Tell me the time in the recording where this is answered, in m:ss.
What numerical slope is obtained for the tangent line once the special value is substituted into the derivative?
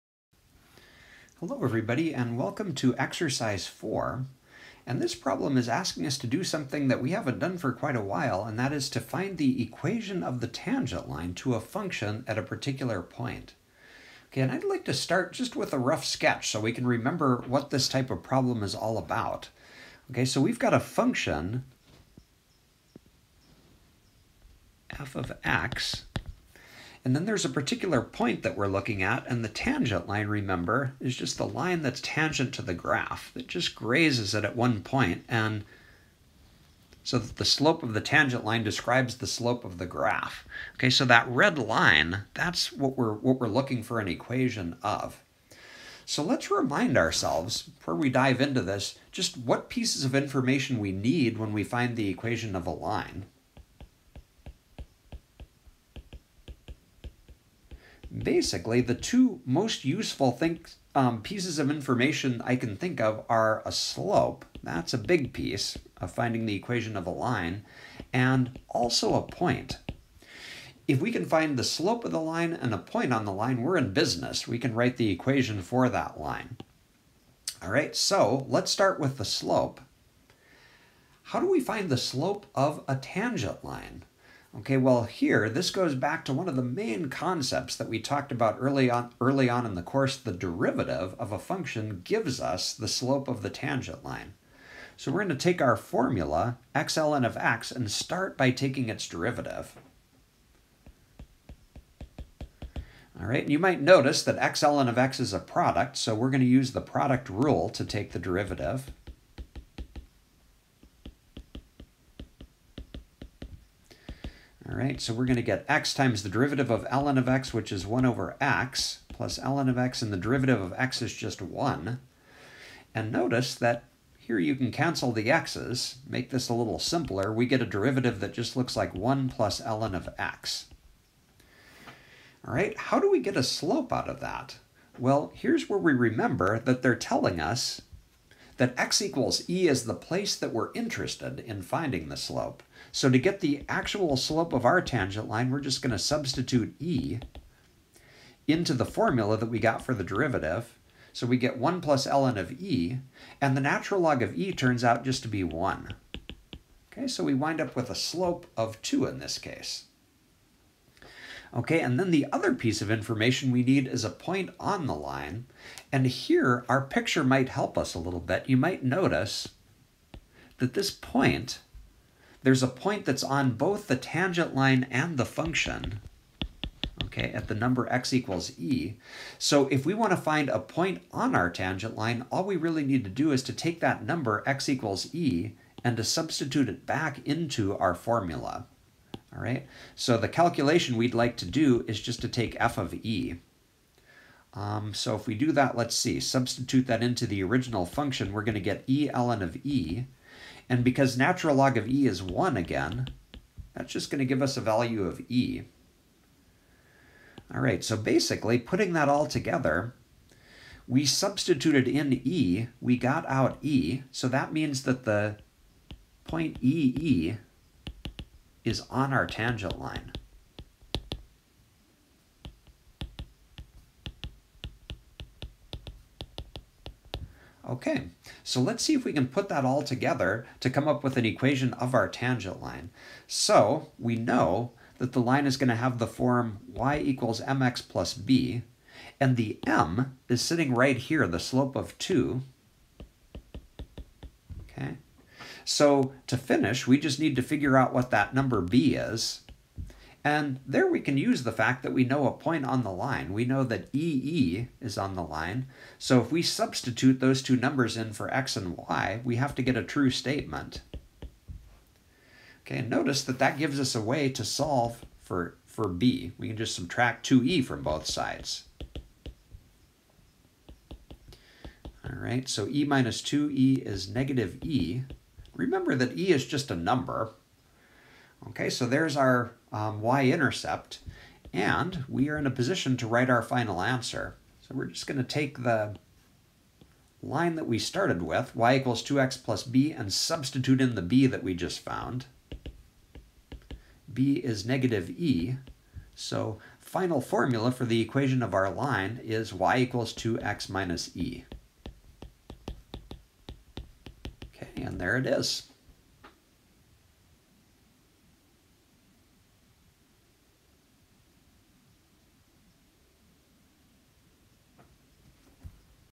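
2:37.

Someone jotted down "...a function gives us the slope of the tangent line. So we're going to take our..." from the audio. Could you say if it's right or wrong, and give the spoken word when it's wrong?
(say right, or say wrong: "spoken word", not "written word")
right.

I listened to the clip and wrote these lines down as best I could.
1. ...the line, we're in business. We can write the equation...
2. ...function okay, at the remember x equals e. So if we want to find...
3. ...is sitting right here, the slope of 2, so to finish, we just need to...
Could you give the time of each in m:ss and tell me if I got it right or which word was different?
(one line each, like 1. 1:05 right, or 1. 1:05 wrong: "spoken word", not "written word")
1. 1:13 right
2. 2:55 wrong: "number", not "remember"
3. 4:00 right.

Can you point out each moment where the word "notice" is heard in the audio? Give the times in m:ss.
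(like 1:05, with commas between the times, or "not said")
1:43, 2:03, 2:48, 4:22.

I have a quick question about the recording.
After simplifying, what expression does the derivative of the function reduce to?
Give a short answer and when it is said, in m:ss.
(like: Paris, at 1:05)
1 + ln x, at 2:08.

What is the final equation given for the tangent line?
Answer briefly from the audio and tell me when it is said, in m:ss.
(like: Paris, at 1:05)
y = 2x - e, at 4:59.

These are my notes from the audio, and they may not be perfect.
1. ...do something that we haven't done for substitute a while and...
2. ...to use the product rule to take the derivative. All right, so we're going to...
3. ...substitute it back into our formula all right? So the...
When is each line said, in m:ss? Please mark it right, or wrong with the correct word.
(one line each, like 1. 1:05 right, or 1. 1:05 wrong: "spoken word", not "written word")
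1. 0:06 wrong: "quite", not "substitute"
2. 1:46 right
3. 3:06 right.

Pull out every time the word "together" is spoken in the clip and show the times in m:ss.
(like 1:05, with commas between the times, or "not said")
3:29, 3:49.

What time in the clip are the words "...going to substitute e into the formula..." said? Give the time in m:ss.
2:25.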